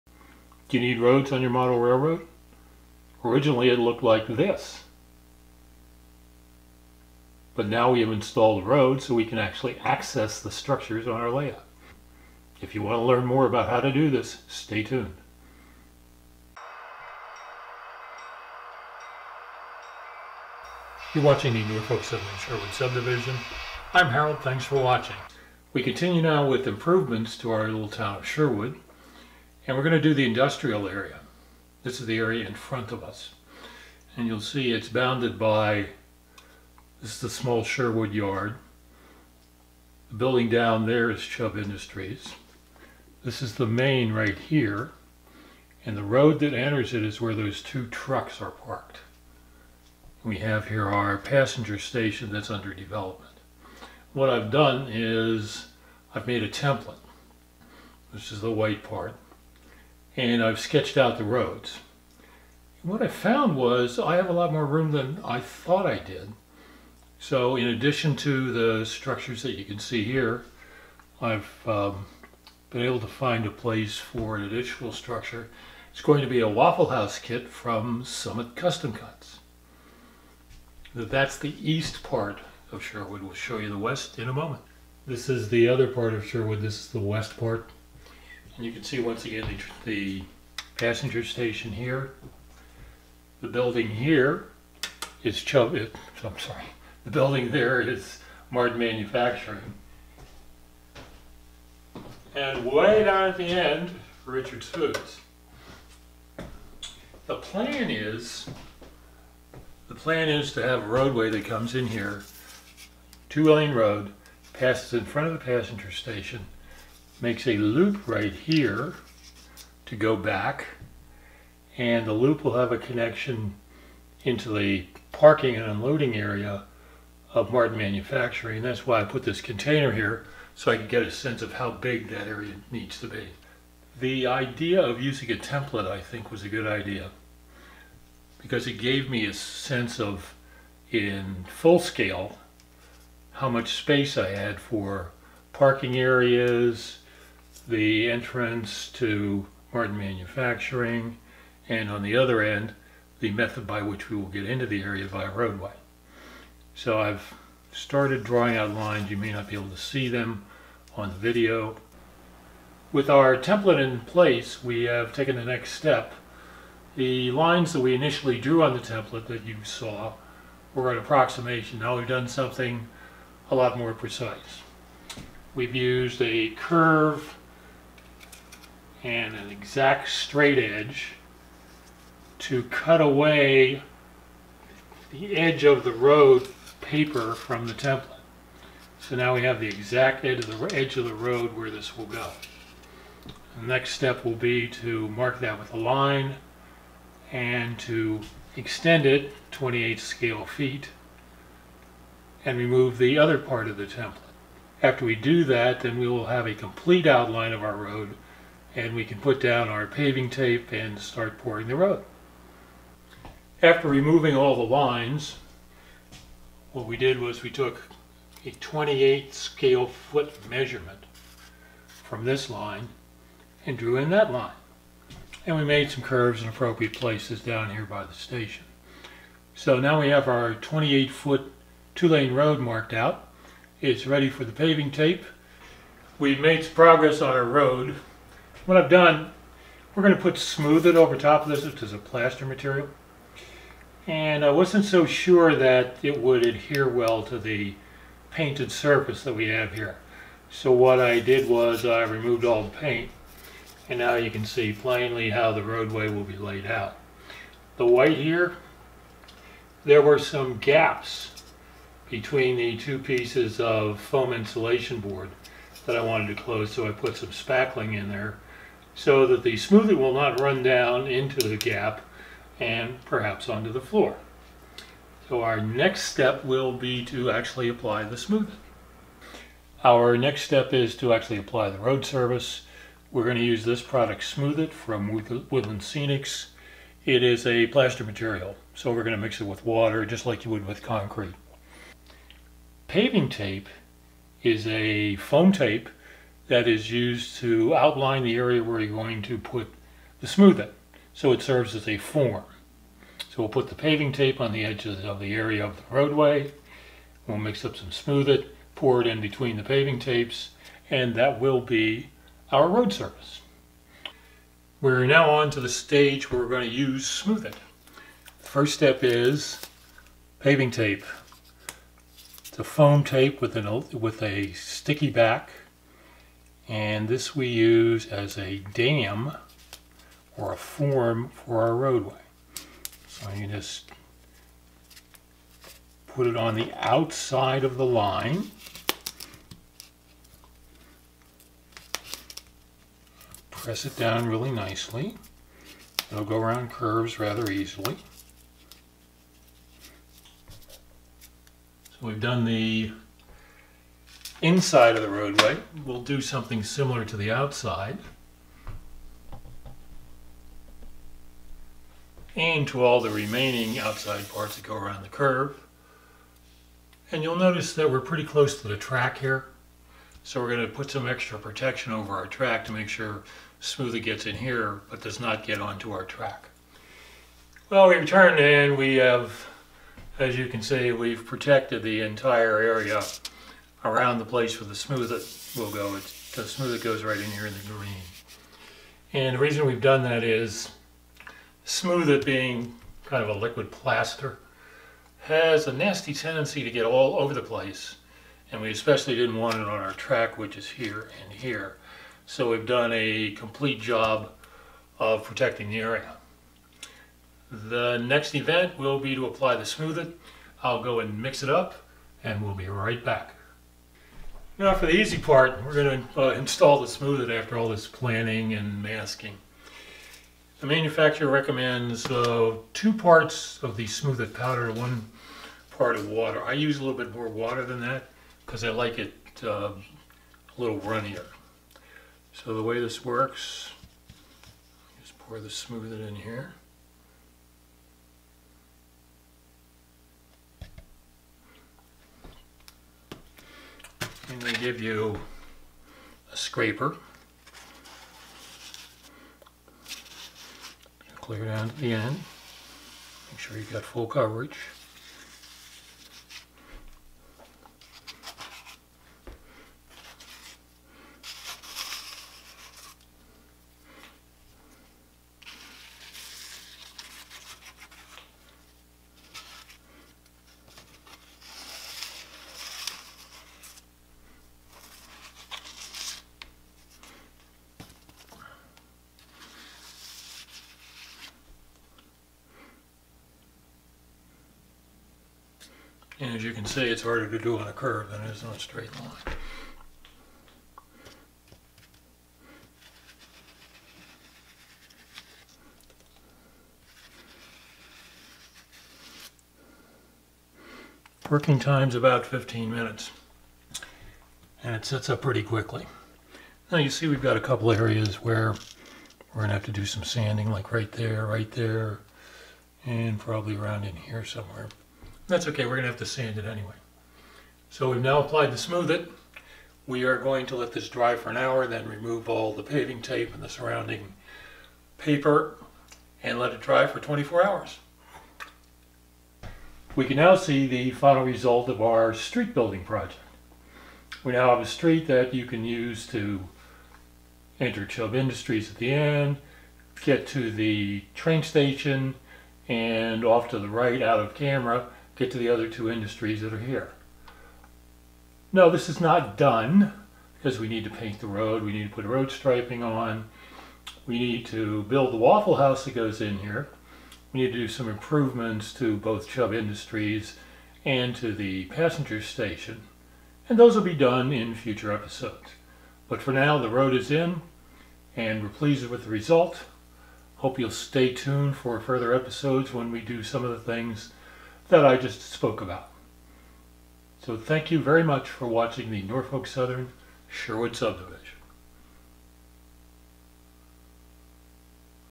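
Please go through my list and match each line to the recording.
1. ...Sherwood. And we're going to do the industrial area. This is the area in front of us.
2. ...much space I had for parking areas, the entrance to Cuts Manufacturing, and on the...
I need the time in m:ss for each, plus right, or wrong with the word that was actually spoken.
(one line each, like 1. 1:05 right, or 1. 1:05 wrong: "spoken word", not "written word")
1. 0:28 right
2. 2:23 wrong: "Martin", not "Cuts".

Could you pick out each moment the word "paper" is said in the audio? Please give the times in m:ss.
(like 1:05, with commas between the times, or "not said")
3:06, 8:44.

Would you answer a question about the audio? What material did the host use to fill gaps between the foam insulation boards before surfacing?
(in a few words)
spackling.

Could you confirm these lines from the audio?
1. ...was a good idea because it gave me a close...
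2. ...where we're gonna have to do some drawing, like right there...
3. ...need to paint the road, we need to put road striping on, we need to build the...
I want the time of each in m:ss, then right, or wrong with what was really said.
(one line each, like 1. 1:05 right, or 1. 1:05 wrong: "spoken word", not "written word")
1. 2:16 wrong: "sense", not "close"
2. 8:28 wrong: "sanding", not "drawing"
3. 9:10 right.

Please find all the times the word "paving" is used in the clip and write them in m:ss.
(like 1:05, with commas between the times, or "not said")
3:29, 3:54, 4:52, 5:03, 5:09, 5:20, 8:42.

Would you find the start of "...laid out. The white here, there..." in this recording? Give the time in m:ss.
4:16.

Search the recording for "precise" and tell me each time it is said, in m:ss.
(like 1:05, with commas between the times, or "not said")
2:53.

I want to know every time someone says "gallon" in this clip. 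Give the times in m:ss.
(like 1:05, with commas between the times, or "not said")
not said.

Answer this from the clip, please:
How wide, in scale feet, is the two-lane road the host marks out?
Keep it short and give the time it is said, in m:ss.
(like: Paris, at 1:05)
28, at 3:19.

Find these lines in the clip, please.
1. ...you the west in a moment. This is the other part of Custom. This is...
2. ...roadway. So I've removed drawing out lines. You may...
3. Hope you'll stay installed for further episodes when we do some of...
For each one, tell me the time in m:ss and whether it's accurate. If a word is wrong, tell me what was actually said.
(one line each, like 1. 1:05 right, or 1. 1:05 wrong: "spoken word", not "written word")
1. 1:23 wrong: "Sherwood", not "Custom"
2. 2:35 wrong: "started", not "removed"
3. 9:30 wrong: "tuned", not "installed".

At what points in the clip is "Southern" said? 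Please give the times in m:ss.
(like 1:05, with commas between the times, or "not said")
0:22, 9:39.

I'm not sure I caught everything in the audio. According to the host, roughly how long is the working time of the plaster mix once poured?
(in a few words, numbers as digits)
15 minutes.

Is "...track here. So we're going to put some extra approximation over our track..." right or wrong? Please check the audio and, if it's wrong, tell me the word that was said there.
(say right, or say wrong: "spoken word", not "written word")
wrong: "protection", not "approximation".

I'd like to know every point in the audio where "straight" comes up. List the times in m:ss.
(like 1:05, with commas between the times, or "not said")
3:00, 8:08.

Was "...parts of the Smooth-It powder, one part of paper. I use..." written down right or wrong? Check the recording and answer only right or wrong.
wrong.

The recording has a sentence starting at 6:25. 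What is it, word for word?
It's, the Smooth-It goes right in here in the green.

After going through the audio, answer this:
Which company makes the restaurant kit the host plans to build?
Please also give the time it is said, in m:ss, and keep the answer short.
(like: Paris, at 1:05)
Summit Custom Cuts, at 1:18.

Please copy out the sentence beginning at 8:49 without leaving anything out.
We can now see the final result of our street building project.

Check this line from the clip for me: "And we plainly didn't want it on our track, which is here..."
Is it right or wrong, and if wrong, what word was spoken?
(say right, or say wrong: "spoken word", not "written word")
wrong: "especially", not "plainly".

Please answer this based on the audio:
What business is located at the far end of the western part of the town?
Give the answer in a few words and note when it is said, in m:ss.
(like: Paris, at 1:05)
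Richard's Foods, at 1:44.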